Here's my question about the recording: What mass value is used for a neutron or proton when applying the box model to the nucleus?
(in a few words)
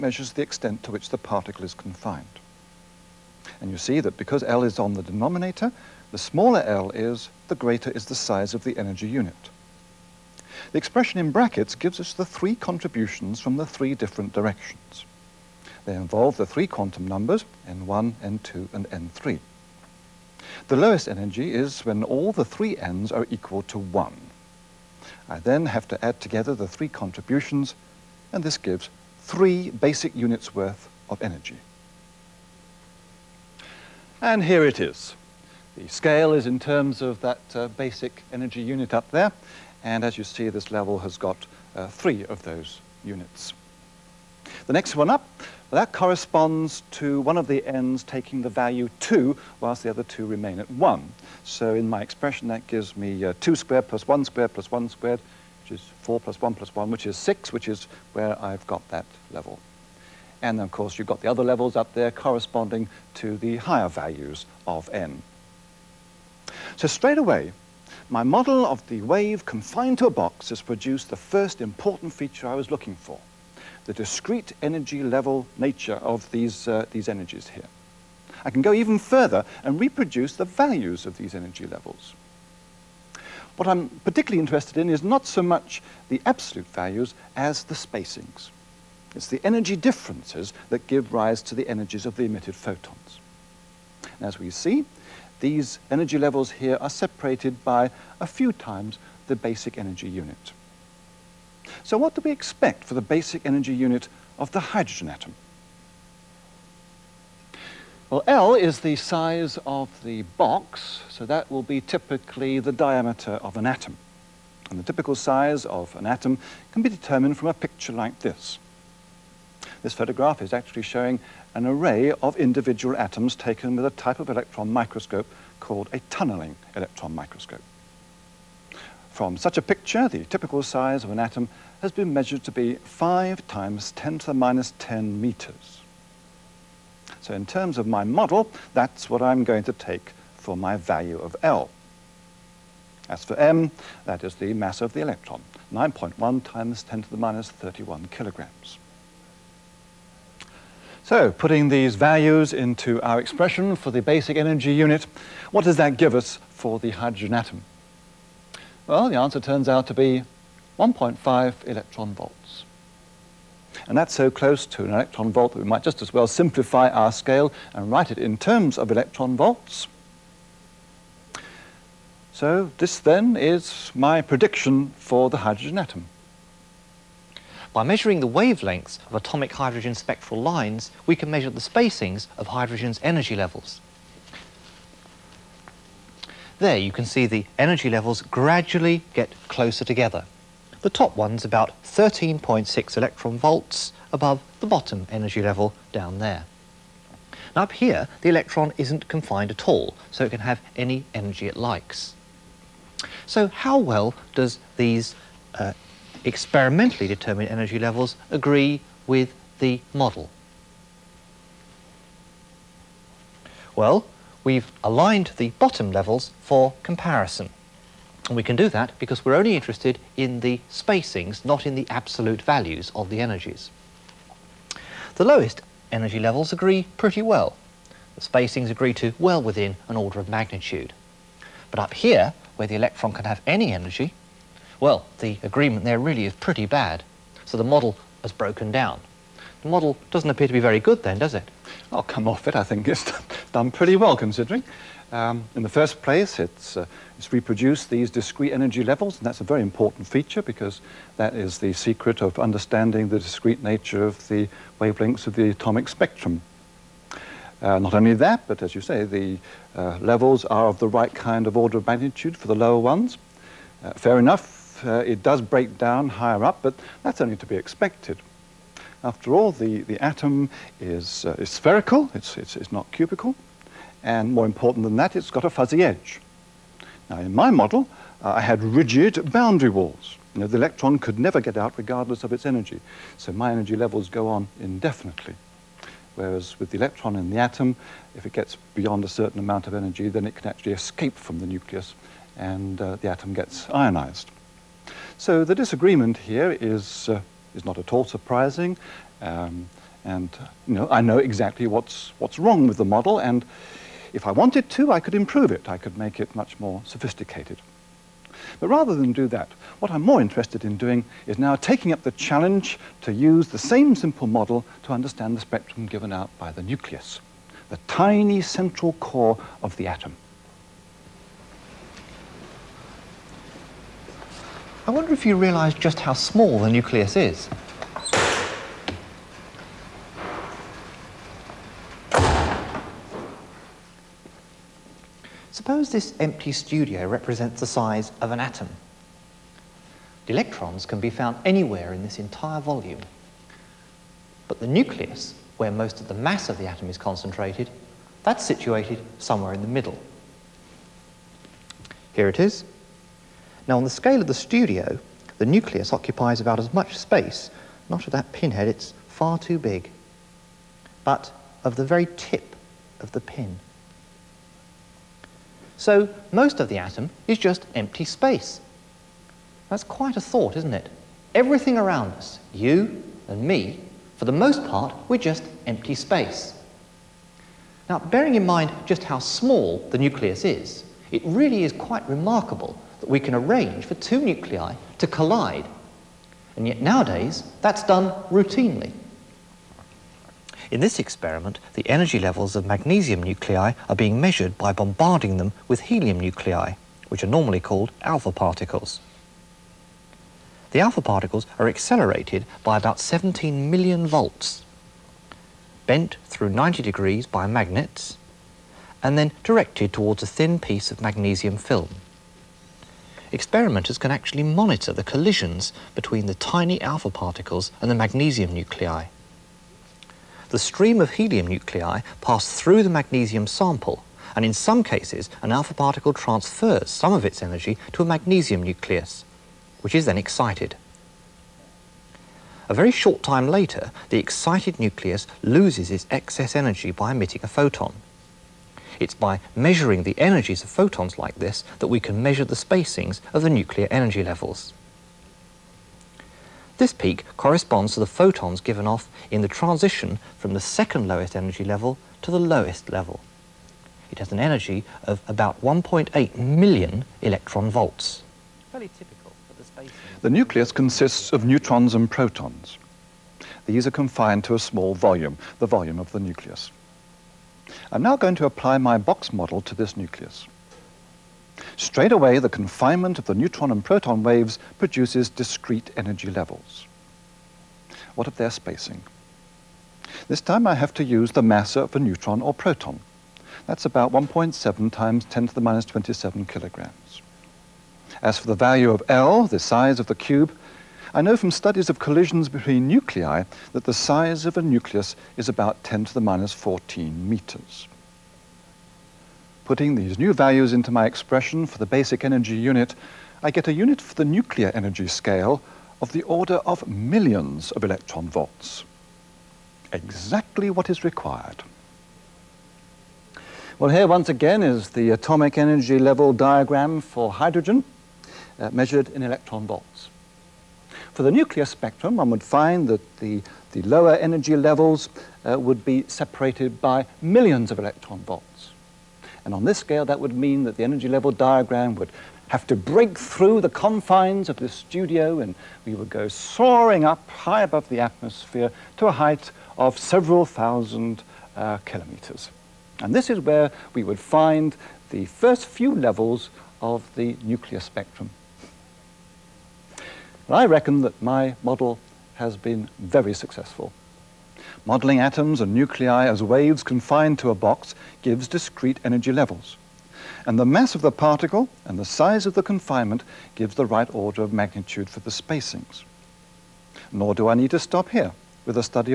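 1.7 x 10^-27 kg.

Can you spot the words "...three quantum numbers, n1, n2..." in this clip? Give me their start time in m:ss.
0:16.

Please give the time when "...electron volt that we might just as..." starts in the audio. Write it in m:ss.
2:44.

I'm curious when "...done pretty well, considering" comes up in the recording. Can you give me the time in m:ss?
4:03.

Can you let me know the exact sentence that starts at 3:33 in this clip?
Well, we've aligned the bottom levels for comparison.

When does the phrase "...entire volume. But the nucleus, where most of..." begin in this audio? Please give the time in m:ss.
5:42.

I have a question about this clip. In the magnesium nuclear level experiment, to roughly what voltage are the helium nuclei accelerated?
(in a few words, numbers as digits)
17 million volts.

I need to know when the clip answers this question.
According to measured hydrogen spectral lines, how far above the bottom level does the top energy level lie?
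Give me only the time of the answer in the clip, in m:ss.
3:11.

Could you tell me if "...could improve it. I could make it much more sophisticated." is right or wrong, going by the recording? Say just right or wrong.
right.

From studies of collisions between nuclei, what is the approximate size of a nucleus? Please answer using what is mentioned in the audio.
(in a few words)
10^-14 meters.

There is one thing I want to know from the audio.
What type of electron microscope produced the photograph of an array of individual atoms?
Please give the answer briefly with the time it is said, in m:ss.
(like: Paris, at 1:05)
tunneling electron microscope, at 2:06.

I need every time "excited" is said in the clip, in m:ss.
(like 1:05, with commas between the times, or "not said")
7:10, 7:14.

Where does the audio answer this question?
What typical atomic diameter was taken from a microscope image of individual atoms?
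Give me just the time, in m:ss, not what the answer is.
2:12.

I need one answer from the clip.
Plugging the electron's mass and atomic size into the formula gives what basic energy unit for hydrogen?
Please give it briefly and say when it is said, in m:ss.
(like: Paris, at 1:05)
1.5 electron volts, at 2:40.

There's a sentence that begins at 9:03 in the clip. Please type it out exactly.
And this is where we would find the first few levels of the nuclear spectrum.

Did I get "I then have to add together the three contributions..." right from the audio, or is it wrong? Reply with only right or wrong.
right.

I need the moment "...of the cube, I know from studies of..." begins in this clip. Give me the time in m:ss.
8:10.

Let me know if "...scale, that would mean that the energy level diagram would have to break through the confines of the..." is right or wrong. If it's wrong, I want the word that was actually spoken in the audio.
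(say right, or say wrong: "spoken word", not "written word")
right.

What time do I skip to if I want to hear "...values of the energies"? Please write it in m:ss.
3:42.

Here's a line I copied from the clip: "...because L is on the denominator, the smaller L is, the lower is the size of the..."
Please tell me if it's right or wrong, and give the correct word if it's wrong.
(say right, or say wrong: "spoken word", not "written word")
wrong: "greater", not "lower".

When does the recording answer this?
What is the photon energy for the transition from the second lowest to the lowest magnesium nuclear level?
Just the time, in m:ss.
7:35.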